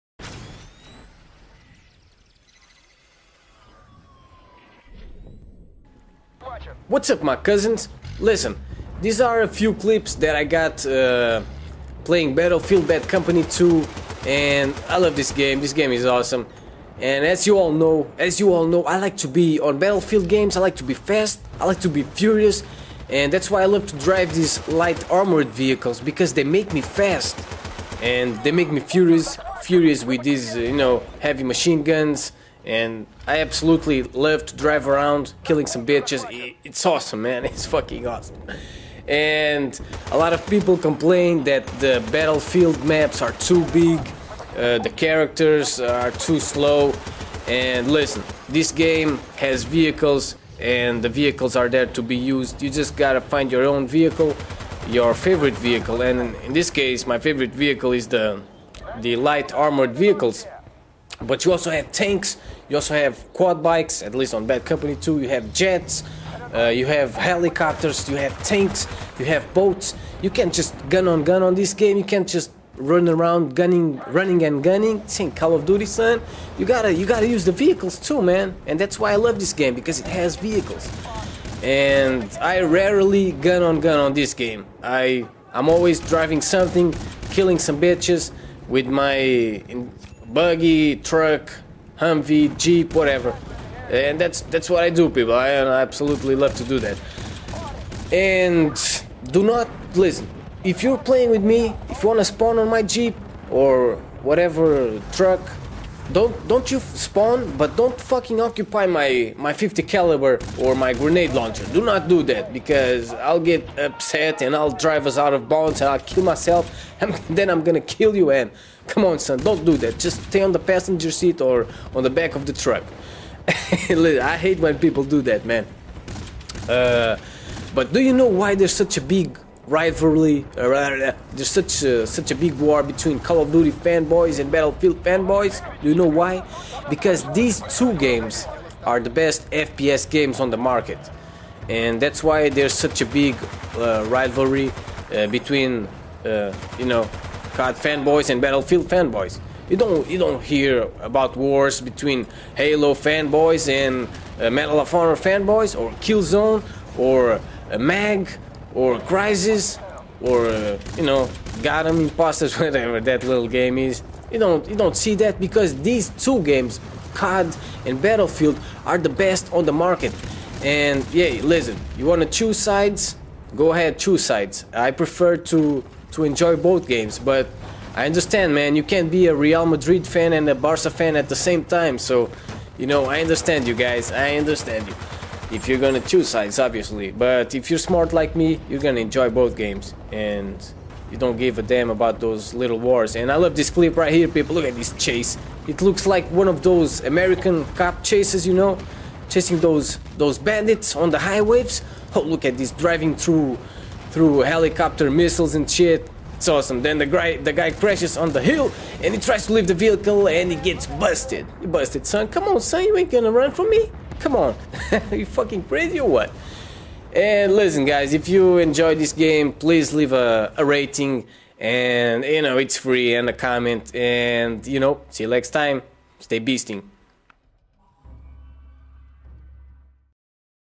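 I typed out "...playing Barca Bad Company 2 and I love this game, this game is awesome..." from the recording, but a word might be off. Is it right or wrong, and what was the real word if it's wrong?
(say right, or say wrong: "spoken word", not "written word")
wrong: "Battlefield", not "Barca".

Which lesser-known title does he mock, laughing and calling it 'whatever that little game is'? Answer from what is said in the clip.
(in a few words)
Gotham Impostors.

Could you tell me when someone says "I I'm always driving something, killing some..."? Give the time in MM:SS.
01:24.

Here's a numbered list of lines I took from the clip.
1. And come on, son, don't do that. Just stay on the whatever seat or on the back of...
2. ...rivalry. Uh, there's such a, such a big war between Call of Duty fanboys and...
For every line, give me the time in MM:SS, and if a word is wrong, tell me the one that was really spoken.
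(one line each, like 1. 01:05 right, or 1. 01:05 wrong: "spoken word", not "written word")
1. 01:58 wrong: "passenger", not "whatever"
2. 02:09 right.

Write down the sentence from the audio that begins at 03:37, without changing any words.
And listen, guys, if you enjoyed this game, please leave a, a rating.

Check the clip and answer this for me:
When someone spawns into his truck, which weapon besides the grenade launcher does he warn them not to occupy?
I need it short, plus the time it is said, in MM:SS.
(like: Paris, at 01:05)
50 caliber, at 01:49.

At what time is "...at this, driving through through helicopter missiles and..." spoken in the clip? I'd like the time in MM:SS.
03:22.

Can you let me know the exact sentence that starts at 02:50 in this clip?
And yeah, listen, you want to choose sides?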